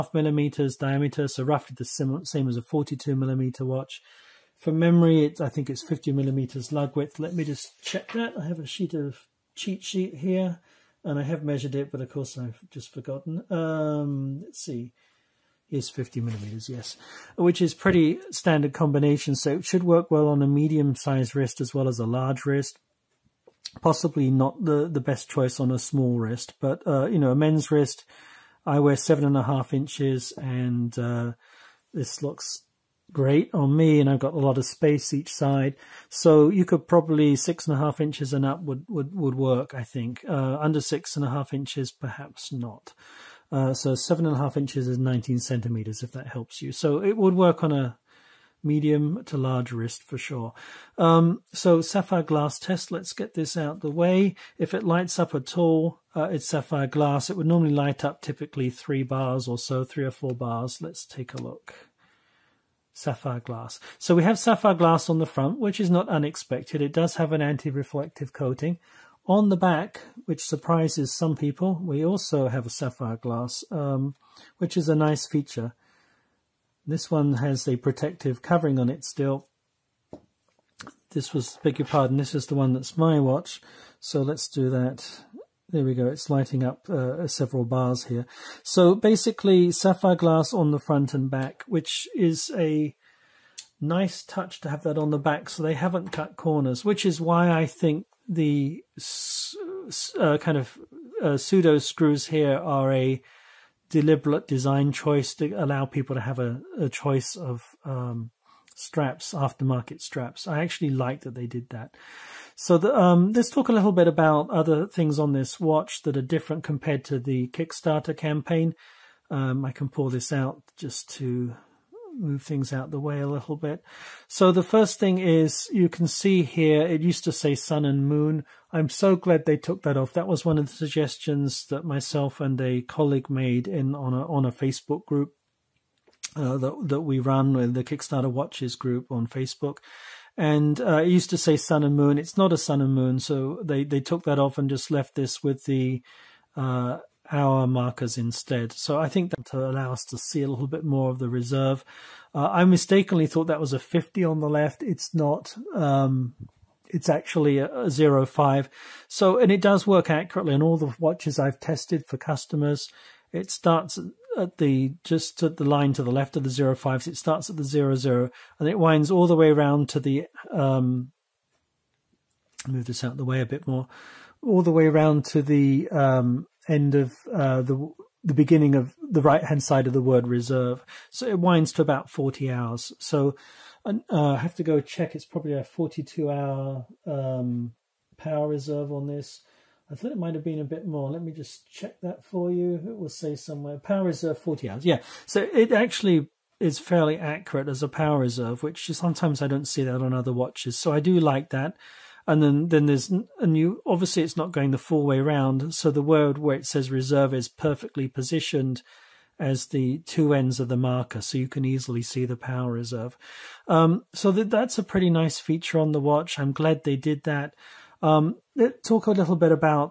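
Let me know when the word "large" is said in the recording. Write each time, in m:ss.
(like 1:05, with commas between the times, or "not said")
0:22, 0:49.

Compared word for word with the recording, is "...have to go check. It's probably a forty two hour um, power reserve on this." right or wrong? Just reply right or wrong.
right.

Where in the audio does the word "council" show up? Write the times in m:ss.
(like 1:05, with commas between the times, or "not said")
not said.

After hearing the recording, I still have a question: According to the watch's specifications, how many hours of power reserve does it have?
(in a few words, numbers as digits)
40 hours.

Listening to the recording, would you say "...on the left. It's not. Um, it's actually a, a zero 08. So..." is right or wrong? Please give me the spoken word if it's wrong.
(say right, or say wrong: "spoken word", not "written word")
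wrong: "05", not "08".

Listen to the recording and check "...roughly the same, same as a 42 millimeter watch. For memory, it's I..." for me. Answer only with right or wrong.
right.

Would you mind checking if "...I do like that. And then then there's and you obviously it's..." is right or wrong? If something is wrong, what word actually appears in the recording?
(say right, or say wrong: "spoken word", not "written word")
right.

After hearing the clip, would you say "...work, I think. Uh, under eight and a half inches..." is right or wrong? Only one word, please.
wrong.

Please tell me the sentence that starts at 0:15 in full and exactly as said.
here's 50 millimeters, yes, which is pretty standard combination.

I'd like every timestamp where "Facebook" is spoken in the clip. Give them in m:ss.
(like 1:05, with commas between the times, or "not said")
2:14, 2:19.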